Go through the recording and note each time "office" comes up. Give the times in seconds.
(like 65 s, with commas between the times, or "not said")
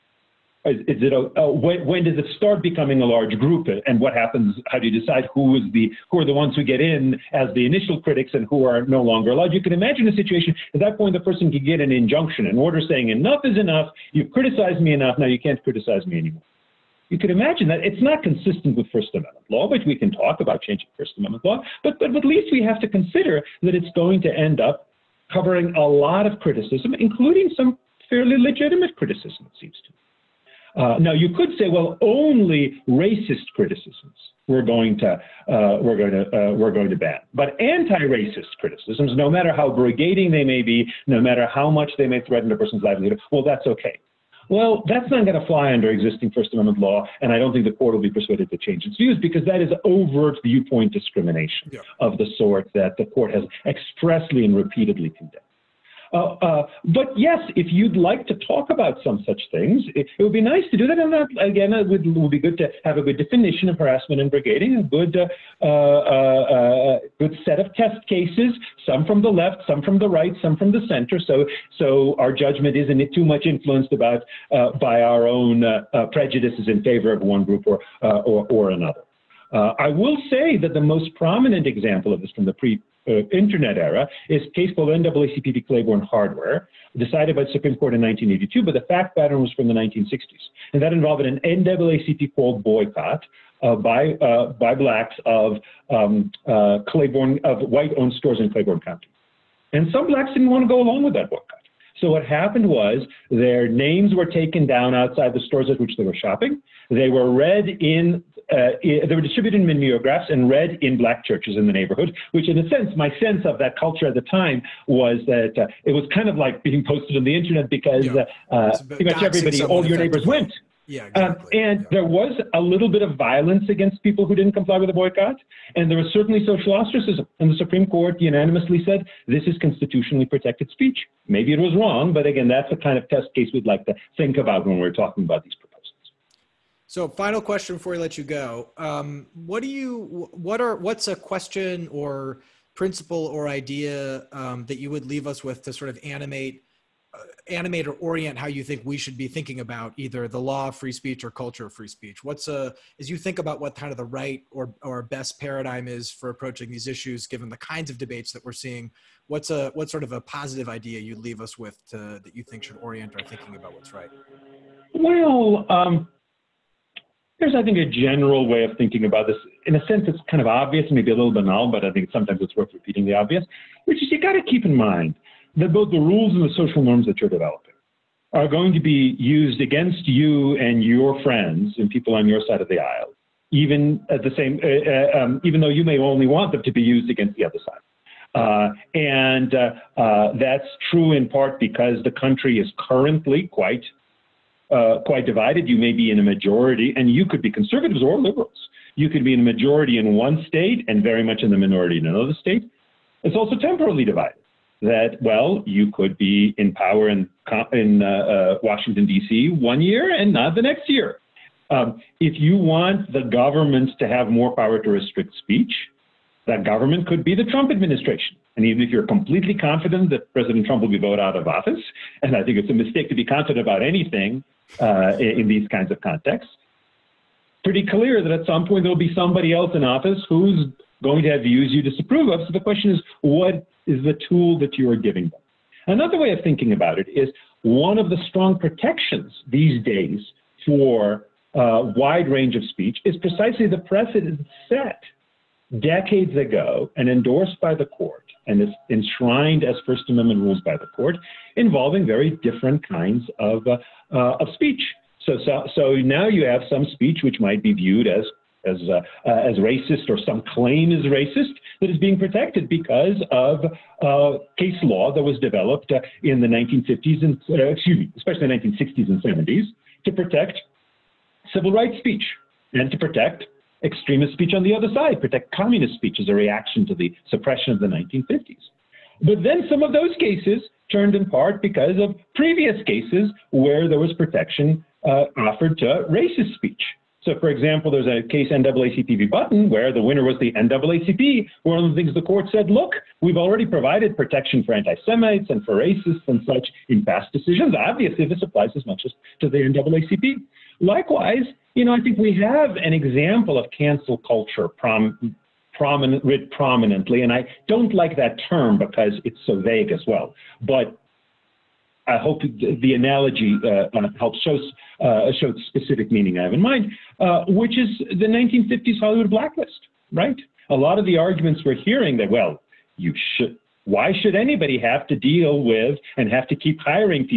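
221 s, 229 s.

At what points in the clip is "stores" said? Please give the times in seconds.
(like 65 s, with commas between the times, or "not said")
98 s, 105 s.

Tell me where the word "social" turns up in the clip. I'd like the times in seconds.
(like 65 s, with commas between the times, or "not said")
126 s, 176 s.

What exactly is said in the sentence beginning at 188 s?
Uh, and uh, uh that's true in part because the country is currently quite uh, quite divided.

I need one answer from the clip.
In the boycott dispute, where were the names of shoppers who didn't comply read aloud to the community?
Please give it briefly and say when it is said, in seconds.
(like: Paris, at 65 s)
black churches, at 110 s.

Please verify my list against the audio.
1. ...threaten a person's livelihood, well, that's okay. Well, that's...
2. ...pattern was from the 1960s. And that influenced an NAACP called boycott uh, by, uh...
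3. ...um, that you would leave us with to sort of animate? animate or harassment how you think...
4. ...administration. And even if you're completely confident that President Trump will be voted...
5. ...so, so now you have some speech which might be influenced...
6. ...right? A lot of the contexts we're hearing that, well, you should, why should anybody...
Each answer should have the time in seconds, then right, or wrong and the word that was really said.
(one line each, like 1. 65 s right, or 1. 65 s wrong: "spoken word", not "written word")
1. 42 s right
2. 89 s wrong: "involved", not "influenced"
3. 144 s wrong: "orient", not "harassment"
4. 217 s right
5. 255 s wrong: "viewed", not "influenced"
6. 320 s wrong: "arguments", not "contexts".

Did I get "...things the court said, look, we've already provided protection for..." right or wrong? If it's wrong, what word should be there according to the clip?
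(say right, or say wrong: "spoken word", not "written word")
right.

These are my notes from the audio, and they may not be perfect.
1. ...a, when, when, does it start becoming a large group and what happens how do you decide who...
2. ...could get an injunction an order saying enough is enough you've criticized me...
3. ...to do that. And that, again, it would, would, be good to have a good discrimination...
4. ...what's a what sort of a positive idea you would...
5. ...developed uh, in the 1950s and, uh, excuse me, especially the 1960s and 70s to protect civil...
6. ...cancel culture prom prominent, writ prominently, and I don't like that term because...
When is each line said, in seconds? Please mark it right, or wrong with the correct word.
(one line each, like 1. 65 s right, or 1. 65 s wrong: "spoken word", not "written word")
1. 1 s right
2. 11 s right
3. 60 s wrong: "definition", not "discrimination"
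4. 159 s right
5. 265 s right
6. 303 s right.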